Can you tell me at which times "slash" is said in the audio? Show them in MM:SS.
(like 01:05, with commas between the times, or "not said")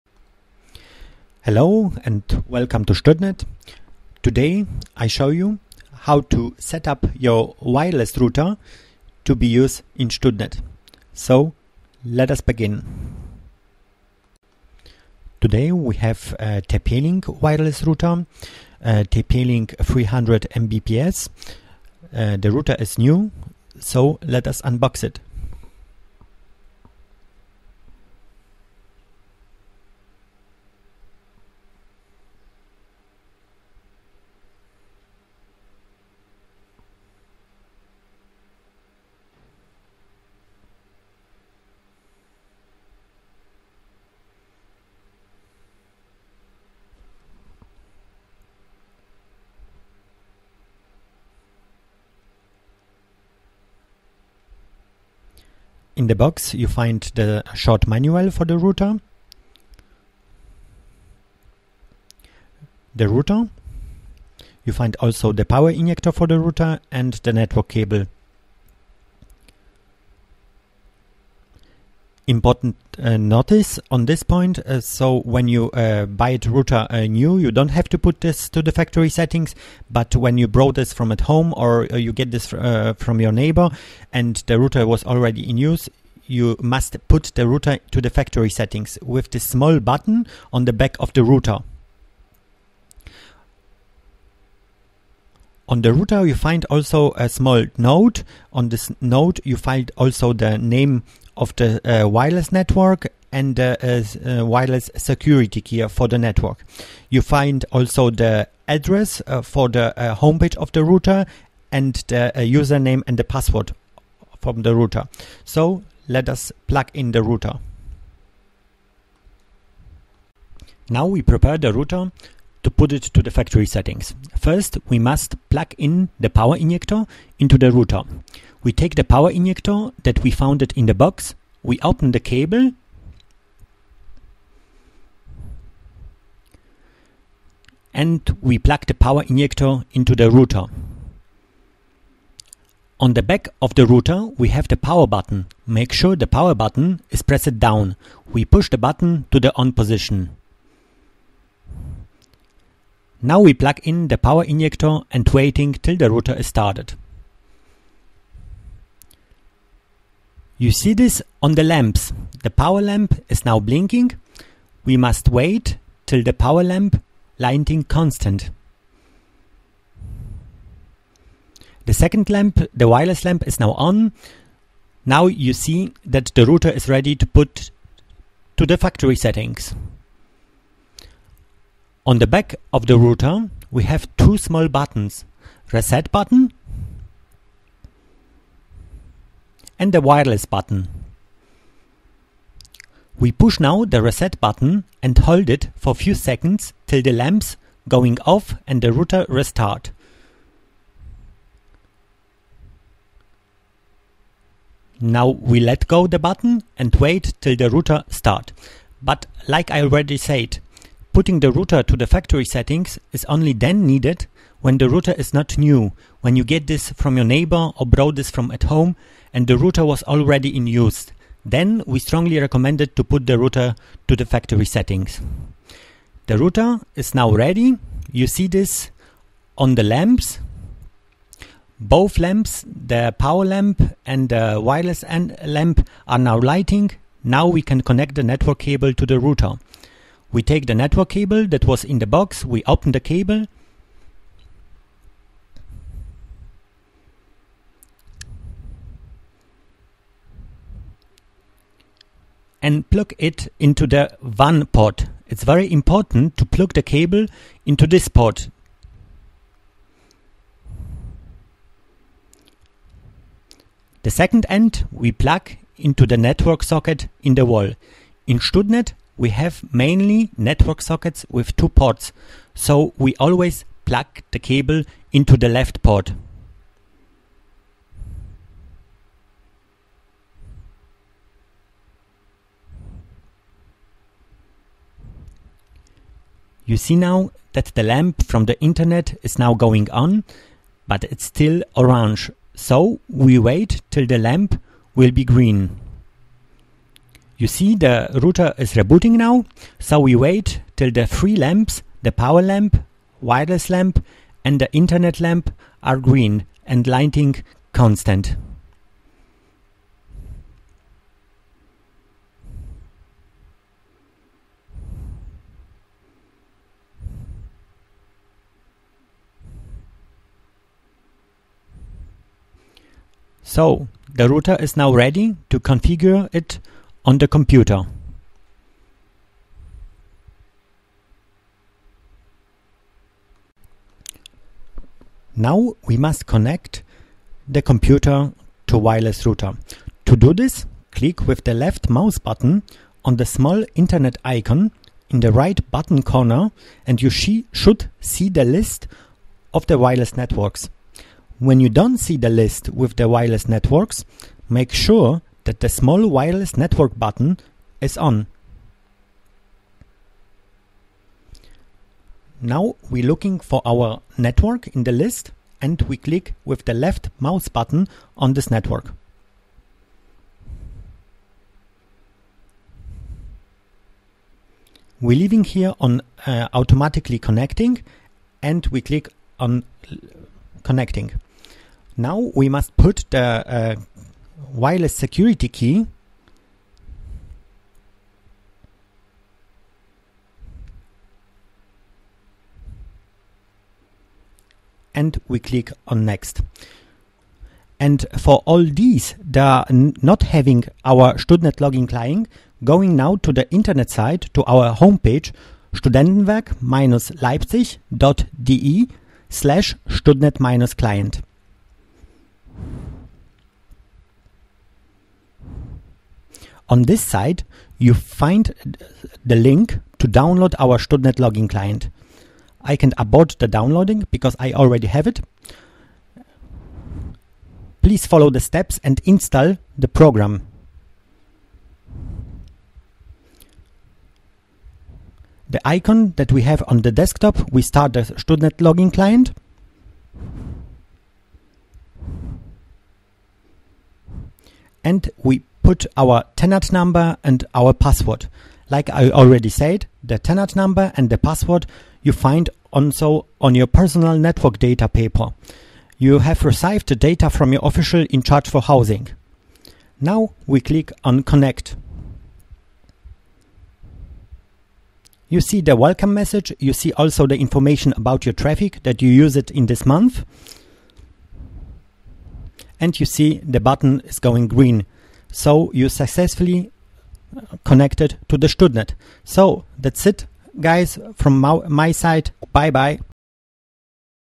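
06:49.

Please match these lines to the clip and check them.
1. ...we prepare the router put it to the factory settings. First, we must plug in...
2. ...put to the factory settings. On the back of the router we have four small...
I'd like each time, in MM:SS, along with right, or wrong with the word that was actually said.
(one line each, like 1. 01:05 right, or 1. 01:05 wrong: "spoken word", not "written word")
1. 02:01 right
2. 02:57 wrong: "two", not "four".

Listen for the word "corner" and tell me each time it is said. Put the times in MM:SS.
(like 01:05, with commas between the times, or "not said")
05:46.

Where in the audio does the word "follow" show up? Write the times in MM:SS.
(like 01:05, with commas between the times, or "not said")
07:08.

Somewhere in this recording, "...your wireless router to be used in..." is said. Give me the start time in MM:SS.
00:07.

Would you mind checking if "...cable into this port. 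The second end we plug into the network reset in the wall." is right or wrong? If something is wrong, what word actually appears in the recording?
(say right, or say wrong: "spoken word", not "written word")
wrong: "socket", not "reset".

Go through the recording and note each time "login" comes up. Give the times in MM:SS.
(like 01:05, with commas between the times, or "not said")
06:41, 07:01, 07:18.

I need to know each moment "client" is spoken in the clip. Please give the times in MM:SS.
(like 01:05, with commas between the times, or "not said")
06:41, 06:49, 07:01, 07:18.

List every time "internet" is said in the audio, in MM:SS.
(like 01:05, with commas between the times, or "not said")
04:48, 05:04, 05:43, 06:43.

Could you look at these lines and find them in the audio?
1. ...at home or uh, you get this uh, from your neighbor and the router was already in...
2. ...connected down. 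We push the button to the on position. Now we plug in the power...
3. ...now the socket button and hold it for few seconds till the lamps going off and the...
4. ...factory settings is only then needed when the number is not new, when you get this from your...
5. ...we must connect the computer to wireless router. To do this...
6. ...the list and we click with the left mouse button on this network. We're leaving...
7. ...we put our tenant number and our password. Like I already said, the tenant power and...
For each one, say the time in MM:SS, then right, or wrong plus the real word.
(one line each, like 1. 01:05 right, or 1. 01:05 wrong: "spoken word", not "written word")
1. 01:21 right
2. 02:27 wrong: "pressed", not "connected"
3. 03:13 wrong: "reset", not "socket"
4. 03:32 wrong: "router", not "number"
5. 05:35 right
6. 06:04 right
7. 07:25 wrong: "number", not "power".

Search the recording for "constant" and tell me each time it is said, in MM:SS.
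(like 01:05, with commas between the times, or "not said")
02:47, 05:07.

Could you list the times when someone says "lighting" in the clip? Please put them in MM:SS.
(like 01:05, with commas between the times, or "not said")
02:47, 03:56, 05:06.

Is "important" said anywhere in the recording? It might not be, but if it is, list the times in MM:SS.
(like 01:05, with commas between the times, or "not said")
01:12, 04:15.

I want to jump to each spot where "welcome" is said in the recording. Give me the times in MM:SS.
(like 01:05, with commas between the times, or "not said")
00:02, 07:45.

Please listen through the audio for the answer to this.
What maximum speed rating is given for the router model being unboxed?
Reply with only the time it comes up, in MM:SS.
00:19.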